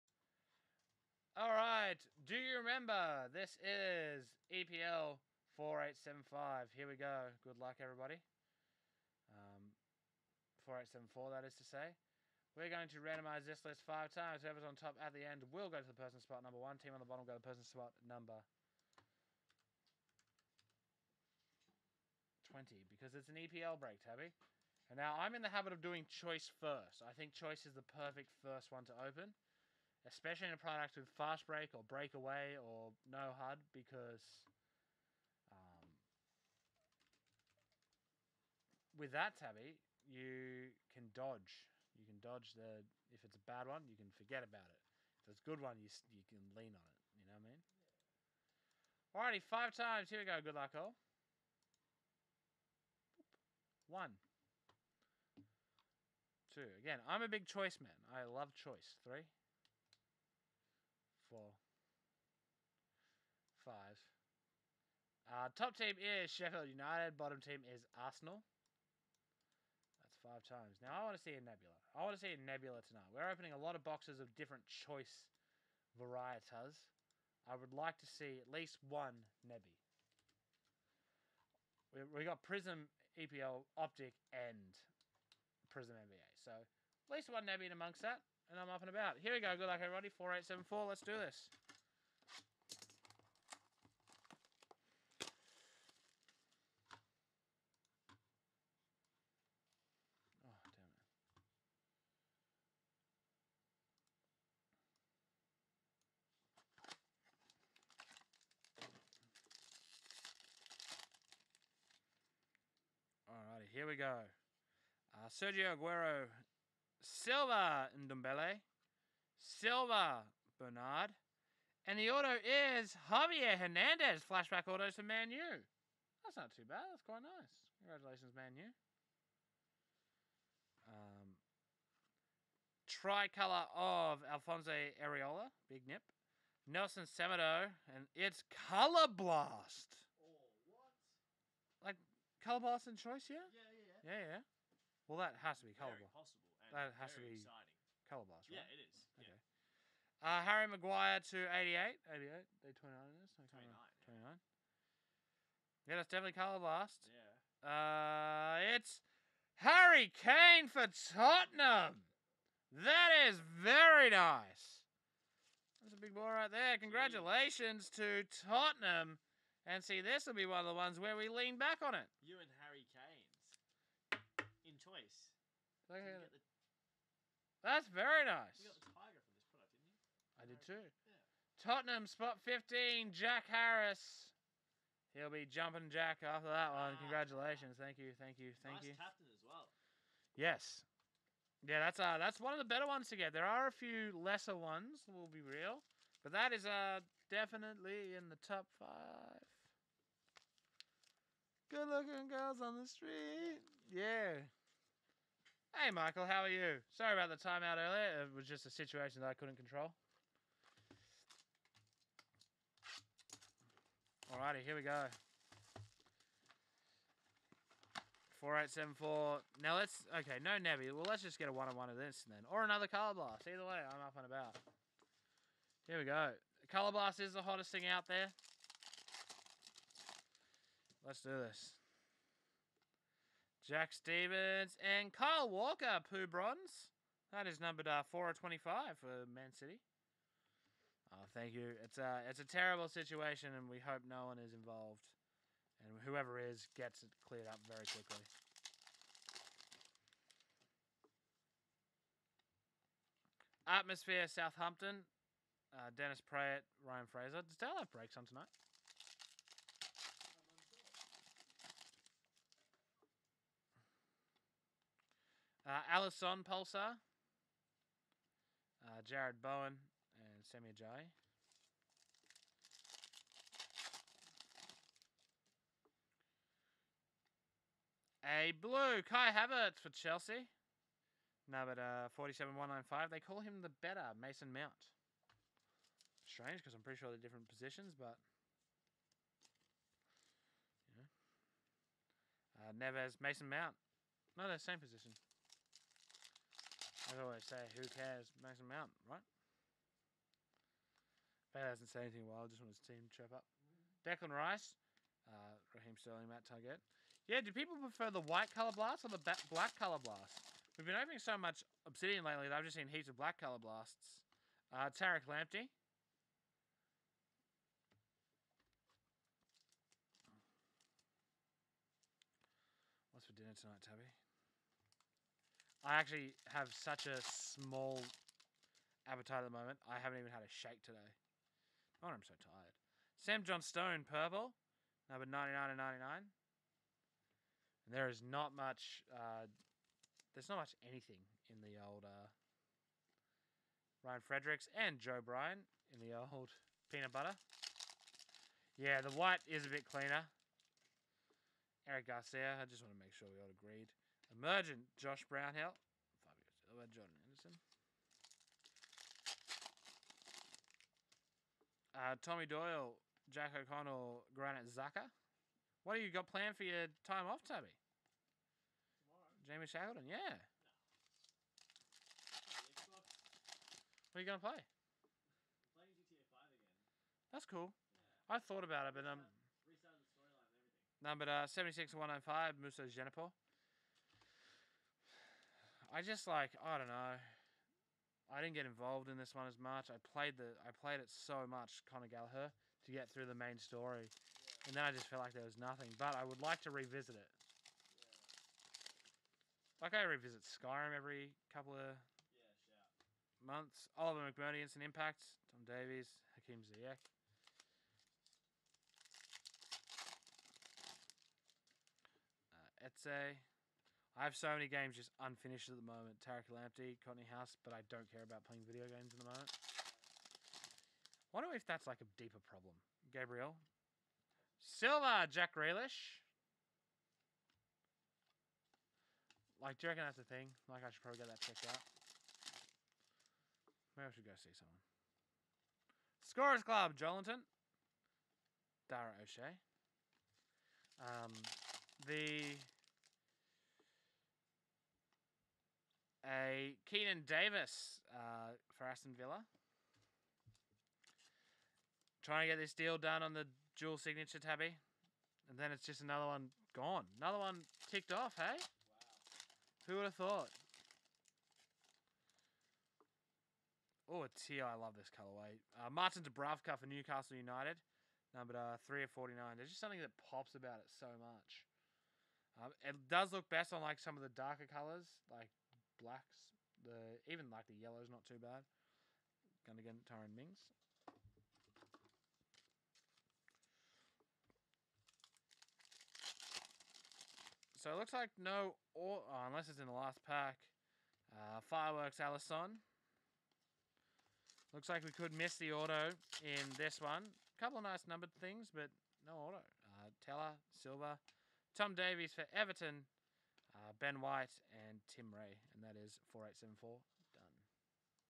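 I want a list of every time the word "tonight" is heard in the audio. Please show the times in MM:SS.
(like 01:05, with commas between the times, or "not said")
01:12, 04:18, 05:23.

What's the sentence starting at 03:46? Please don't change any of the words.
Color Blast is the hottest thing out there.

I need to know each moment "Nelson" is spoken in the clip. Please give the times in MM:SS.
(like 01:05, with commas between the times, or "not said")
02:16.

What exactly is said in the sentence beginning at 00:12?
We're going to randomize this list five times.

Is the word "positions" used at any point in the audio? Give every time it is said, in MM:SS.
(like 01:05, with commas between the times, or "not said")
04:47, 04:54.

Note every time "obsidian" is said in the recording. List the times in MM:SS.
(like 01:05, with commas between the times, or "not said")
05:11.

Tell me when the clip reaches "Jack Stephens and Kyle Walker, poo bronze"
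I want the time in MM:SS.
03:53.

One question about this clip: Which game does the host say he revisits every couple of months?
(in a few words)
Skyrim.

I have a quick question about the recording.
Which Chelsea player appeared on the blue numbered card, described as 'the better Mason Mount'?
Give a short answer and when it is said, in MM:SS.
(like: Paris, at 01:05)
Kai Havertz, at 04:39.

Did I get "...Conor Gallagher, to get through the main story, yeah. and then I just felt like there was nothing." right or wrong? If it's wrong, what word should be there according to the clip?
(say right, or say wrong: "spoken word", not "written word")
right.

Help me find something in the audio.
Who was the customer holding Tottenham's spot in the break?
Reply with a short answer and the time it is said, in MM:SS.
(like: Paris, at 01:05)
Jack Harris, at 03:03.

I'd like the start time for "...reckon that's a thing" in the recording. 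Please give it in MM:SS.
07:09.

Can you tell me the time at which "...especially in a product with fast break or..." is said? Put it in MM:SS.
00:30.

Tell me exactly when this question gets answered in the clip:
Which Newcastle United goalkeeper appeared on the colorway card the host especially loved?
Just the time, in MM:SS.
07:45.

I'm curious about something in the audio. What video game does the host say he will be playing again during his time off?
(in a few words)
GTA 5.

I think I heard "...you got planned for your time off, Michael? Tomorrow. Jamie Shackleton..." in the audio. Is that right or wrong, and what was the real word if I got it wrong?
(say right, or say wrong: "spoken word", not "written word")
wrong: "Tubby", not "Michael".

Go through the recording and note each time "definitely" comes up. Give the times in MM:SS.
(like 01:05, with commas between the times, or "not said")
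02:36, 03:17.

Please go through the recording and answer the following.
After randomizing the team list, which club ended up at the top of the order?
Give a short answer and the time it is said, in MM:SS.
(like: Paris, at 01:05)
Sheffield United, at 01:06.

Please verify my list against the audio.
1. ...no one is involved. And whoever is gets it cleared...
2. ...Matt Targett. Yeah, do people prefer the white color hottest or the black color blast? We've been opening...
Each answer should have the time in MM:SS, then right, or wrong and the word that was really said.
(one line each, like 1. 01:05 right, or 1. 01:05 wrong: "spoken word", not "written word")
1. 04:04 right
2. 05:06 wrong: "blast", not "hottest".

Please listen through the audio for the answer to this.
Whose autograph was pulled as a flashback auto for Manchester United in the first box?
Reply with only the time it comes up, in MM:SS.
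02:03.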